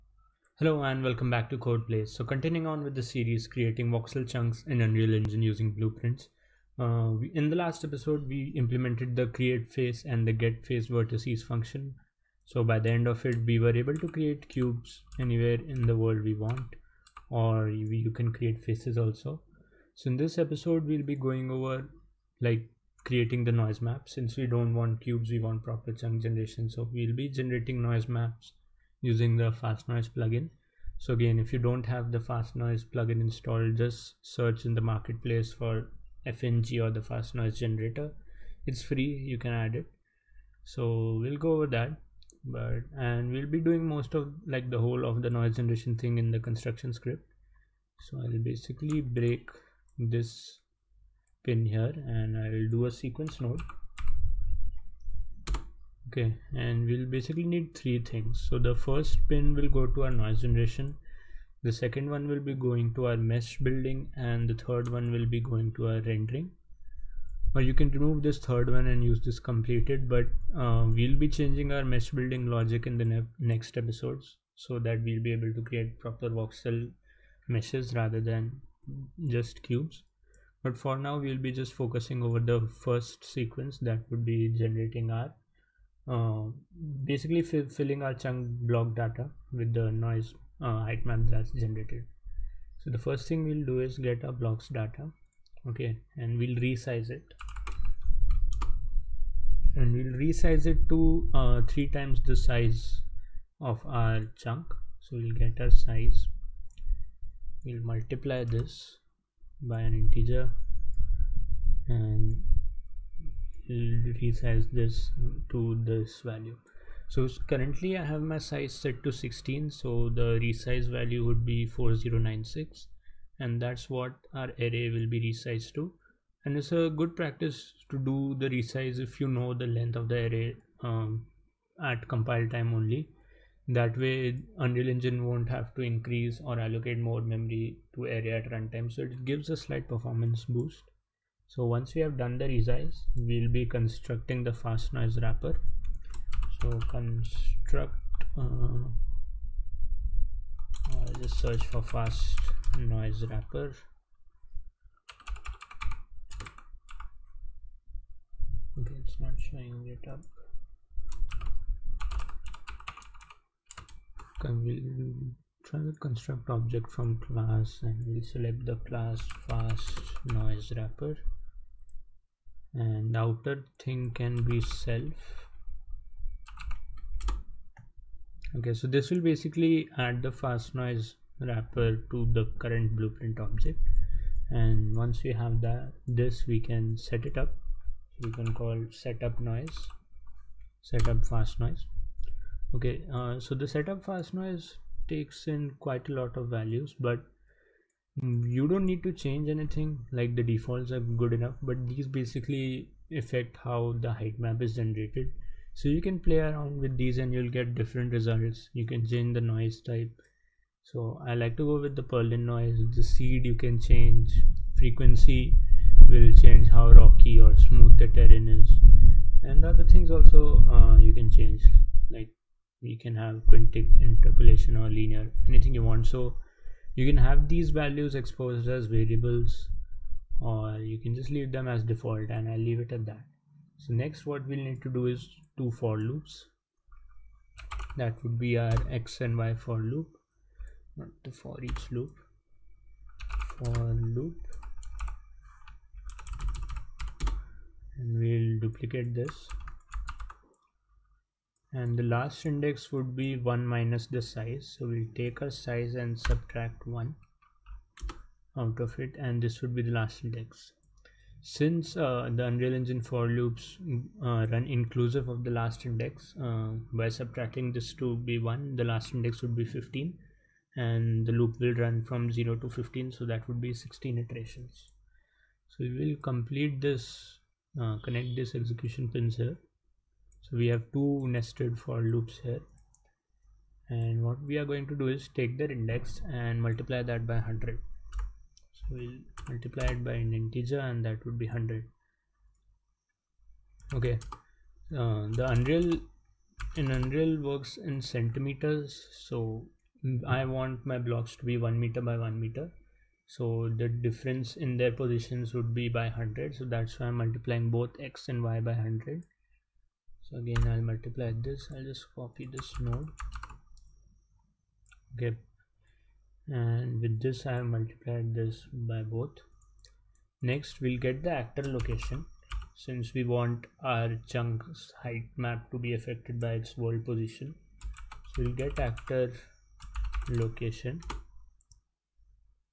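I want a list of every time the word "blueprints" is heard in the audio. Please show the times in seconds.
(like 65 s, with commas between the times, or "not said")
5 s, 182 s.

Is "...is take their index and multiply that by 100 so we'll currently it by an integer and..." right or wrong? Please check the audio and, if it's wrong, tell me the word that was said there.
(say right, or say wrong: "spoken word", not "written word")
wrong: "multiply", not "currently".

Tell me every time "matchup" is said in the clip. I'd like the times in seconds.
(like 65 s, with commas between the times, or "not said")
not said.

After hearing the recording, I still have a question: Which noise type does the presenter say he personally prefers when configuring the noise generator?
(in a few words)
Perlin noise.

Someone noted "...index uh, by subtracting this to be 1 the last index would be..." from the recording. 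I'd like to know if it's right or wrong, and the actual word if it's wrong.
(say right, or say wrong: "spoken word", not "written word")
right.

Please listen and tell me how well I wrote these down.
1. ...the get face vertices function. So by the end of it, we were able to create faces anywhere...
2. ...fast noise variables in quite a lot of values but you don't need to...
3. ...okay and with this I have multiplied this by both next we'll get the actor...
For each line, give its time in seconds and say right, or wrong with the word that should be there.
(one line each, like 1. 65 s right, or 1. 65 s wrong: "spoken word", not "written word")
1. 10 s wrong: "cubes", not "faces"
2. 194 s wrong: "takes", not "variables"
3. 315 s right.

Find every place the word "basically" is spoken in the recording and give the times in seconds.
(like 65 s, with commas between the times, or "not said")
48 s, 57 s, 87 s, 179 s, 202 s.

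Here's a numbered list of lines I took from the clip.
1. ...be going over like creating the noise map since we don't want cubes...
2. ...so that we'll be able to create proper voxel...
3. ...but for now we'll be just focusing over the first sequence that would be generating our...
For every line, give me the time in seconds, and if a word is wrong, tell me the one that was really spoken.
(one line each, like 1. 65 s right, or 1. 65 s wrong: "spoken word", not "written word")
1. 21 s right
2. 74 s right
3. 80 s right.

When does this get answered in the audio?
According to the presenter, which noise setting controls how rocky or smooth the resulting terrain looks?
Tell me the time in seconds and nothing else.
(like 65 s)
214 s.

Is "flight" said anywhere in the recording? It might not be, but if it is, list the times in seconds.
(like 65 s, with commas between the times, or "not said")
not said.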